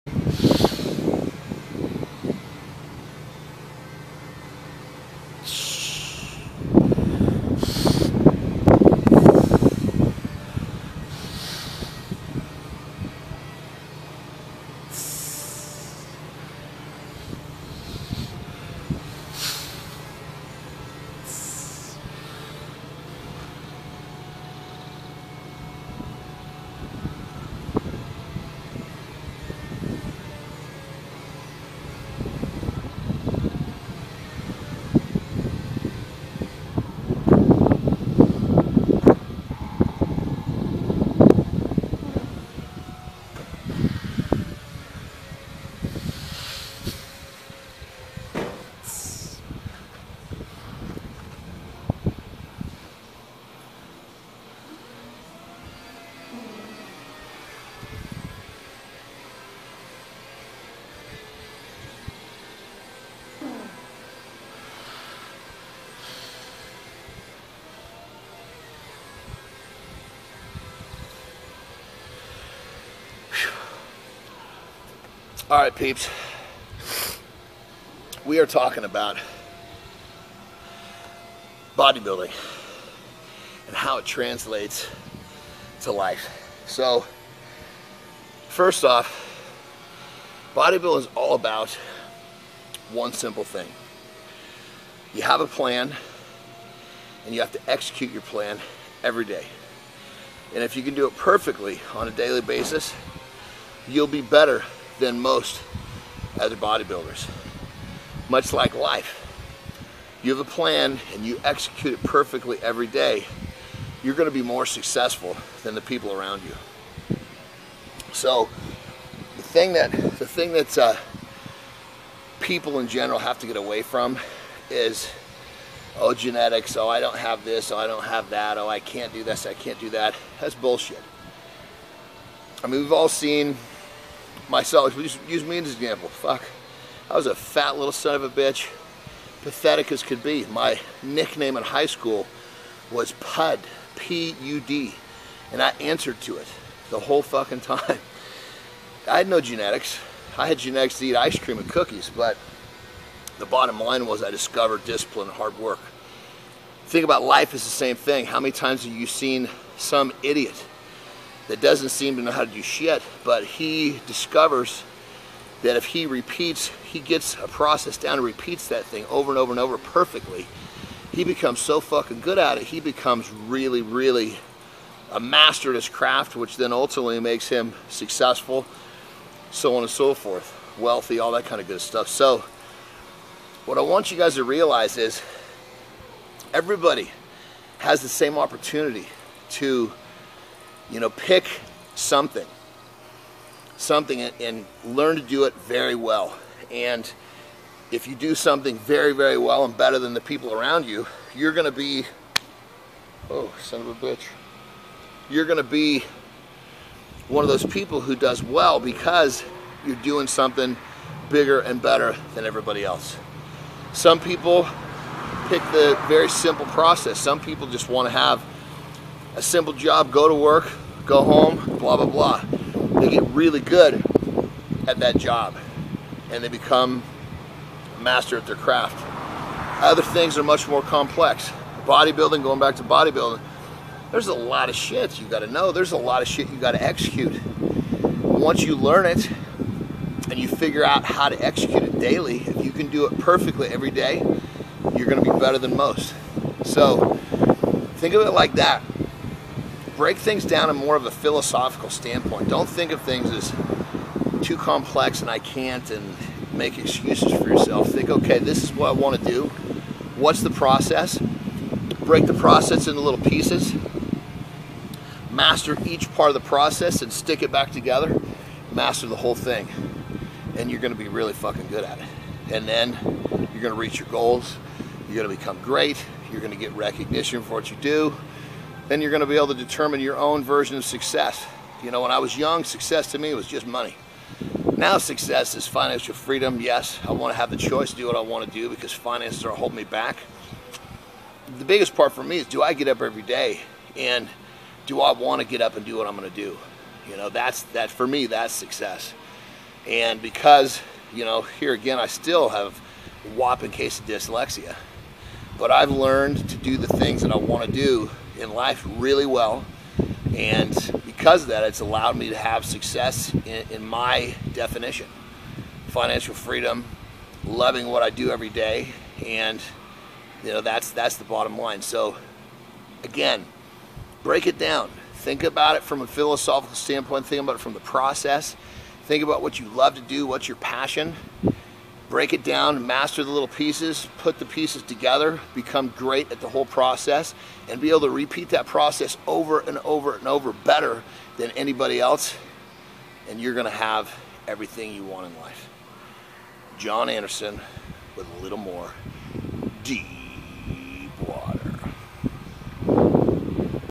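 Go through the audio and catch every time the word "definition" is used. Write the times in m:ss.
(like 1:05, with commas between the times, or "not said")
5:14.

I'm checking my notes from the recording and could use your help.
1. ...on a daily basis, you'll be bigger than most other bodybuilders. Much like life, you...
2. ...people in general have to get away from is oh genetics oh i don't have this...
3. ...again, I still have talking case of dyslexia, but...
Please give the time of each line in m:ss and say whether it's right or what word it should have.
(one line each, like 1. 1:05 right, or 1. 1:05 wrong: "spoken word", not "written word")
1. 1:41 wrong: "better", not "bigger"
2. 2:02 right
3. 5:01 wrong: "whopping", not "talking".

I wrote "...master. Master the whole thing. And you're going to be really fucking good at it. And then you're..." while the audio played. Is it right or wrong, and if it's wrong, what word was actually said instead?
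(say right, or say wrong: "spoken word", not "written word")
wrong: "together", not "master".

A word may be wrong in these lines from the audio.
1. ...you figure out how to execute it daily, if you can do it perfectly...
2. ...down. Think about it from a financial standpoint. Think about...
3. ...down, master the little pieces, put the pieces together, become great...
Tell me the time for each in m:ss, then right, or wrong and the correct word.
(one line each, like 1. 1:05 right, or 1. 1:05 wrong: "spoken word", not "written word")
1. 4:00 right
2. 5:24 wrong: "philosophical", not "financial"
3. 5:32 right.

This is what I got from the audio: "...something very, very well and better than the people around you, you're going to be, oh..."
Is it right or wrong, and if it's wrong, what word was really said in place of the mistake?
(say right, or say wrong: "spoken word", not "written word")
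right.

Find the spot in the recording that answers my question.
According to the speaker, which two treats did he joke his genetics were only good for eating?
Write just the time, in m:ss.
2:31.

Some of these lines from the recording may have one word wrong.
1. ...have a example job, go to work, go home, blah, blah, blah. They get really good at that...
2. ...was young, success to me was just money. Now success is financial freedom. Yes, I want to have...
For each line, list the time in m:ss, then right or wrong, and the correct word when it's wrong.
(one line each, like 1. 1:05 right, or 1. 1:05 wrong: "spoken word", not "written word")
1. 3:38 wrong: "simple", not "example"
2. 4:42 right.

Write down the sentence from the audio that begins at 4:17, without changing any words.
Think, okay, this is what I want to do.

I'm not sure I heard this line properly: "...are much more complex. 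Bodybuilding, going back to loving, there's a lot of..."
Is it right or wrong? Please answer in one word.
wrong.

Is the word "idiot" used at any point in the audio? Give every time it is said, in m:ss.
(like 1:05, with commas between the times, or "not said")
2:40.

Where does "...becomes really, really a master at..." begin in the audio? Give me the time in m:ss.
2:52.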